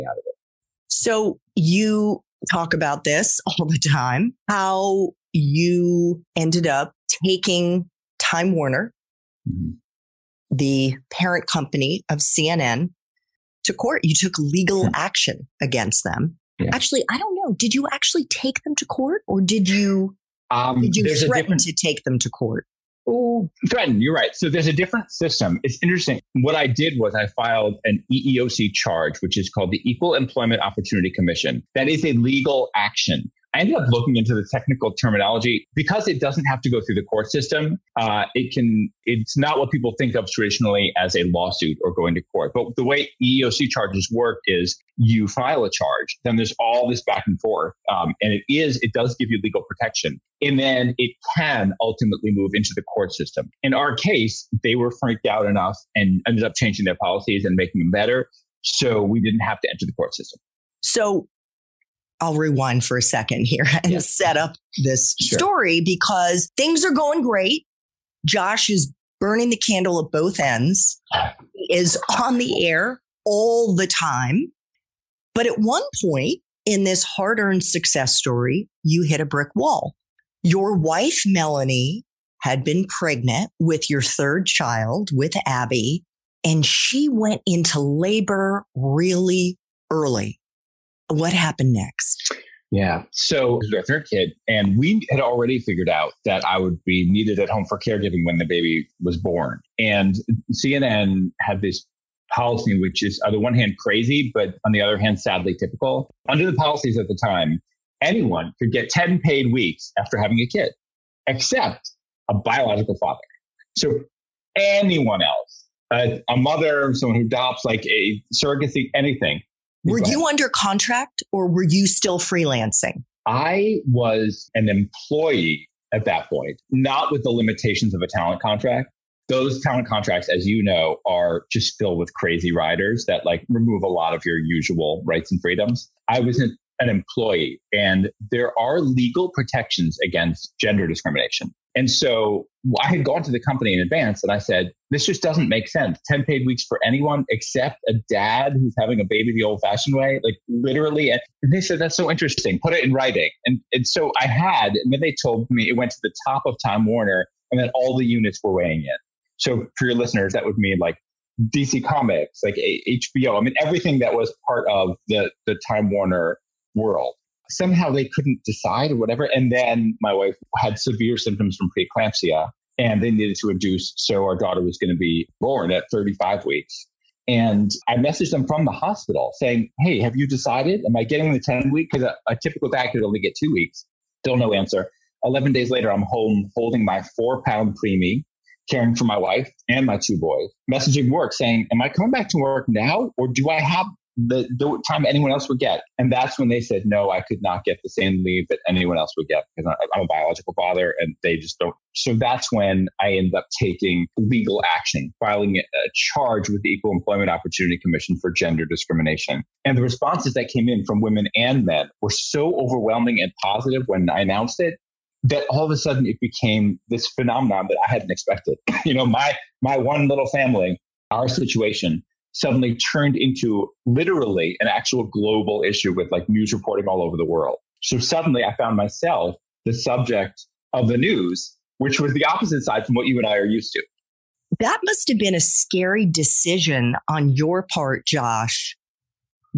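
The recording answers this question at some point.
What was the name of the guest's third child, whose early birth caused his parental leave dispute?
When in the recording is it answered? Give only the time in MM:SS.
01:25.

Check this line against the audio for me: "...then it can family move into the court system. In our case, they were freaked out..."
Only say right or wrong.
wrong.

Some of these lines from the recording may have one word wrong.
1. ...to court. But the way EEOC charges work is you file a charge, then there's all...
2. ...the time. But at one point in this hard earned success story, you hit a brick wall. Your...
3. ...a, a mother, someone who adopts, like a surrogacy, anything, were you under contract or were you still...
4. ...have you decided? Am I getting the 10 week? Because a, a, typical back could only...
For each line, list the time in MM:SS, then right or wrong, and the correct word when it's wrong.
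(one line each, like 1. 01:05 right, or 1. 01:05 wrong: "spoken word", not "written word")
1. 00:42 right
2. 01:13 right
3. 01:55 right
4. 02:59 right.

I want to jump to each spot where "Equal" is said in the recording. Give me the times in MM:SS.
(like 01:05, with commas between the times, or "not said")
00:29, 03:26.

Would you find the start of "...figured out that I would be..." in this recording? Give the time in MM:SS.
01:35.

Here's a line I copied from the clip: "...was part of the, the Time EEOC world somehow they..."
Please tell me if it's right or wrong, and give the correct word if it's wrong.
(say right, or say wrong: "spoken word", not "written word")
wrong: "Warner", not "EEOC".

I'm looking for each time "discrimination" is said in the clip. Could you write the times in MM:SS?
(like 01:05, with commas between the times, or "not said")
02:20, 03:28.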